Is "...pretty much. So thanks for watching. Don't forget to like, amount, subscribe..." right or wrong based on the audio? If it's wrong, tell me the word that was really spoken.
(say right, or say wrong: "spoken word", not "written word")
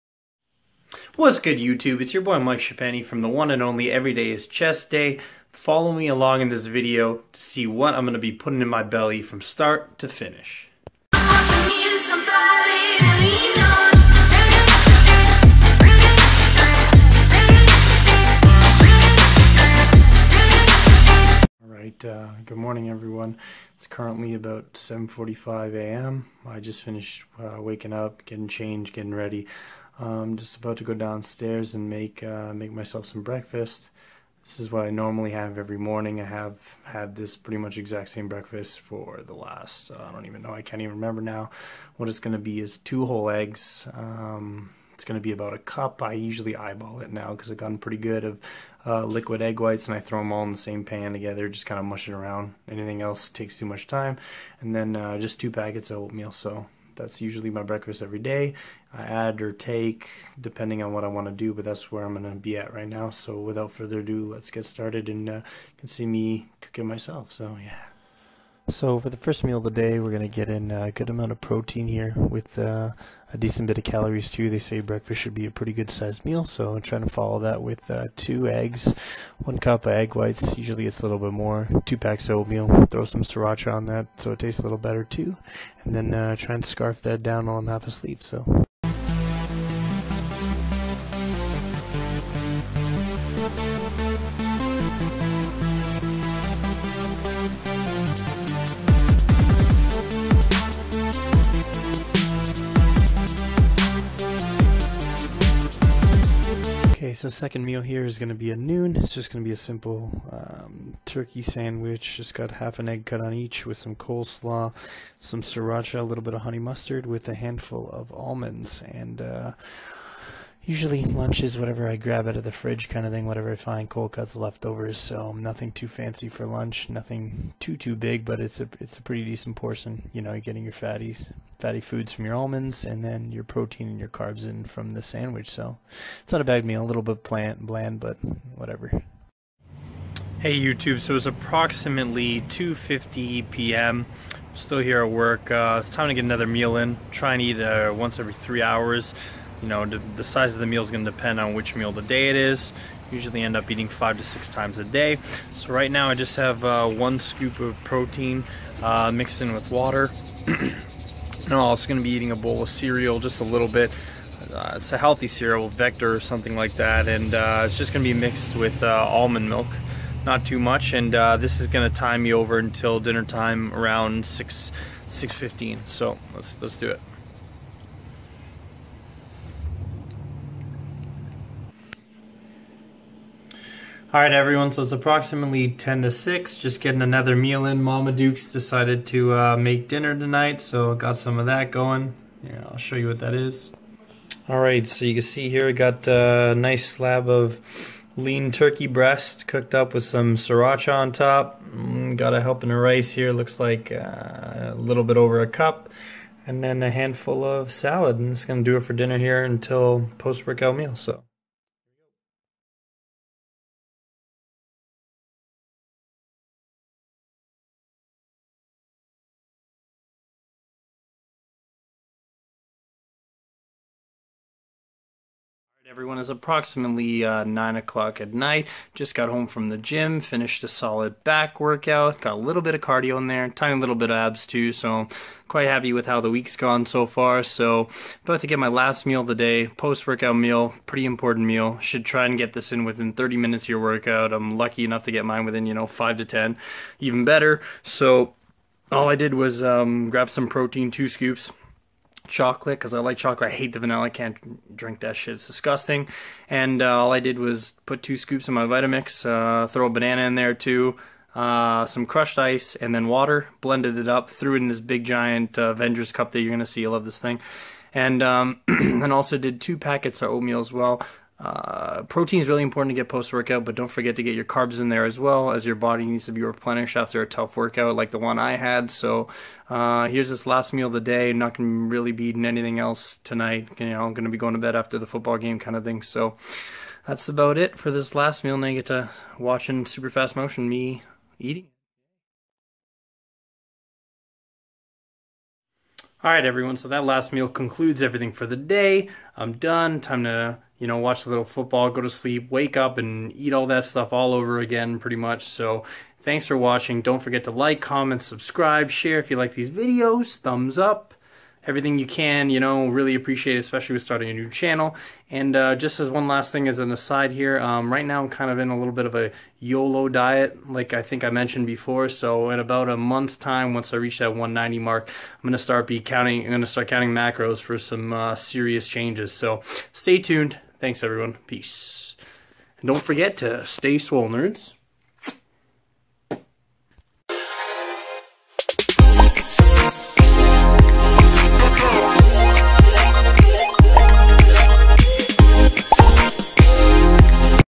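wrong: "comment", not "amount".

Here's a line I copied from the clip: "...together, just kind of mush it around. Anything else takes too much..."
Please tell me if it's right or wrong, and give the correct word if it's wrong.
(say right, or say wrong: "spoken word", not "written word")
right.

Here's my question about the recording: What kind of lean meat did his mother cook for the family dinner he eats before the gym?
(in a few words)
Turkey breast.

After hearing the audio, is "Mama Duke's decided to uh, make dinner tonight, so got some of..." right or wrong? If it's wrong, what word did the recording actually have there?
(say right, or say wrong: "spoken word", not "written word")
right.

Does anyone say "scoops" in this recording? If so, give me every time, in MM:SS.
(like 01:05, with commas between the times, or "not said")
02:37, 04:11, 04:18.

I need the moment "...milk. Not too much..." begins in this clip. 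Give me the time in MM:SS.
02:49.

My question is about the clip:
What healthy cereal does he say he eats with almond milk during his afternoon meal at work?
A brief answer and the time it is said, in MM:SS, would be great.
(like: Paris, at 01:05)
Vector, at 02:45.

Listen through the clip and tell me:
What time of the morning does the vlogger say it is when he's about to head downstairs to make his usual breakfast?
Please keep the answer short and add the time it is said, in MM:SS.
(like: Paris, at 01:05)
7:45 a.m., at 00:24.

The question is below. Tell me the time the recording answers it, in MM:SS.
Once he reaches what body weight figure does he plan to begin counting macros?
05:24.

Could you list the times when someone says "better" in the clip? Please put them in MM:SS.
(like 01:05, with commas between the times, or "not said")
01:24, 04:07.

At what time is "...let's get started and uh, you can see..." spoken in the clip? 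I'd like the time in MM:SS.
01:04.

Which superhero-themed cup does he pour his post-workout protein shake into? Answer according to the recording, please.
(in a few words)
Avengers cup.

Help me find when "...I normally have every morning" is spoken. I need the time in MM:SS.
00:34.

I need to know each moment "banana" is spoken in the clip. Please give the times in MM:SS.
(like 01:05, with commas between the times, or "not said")
04:19.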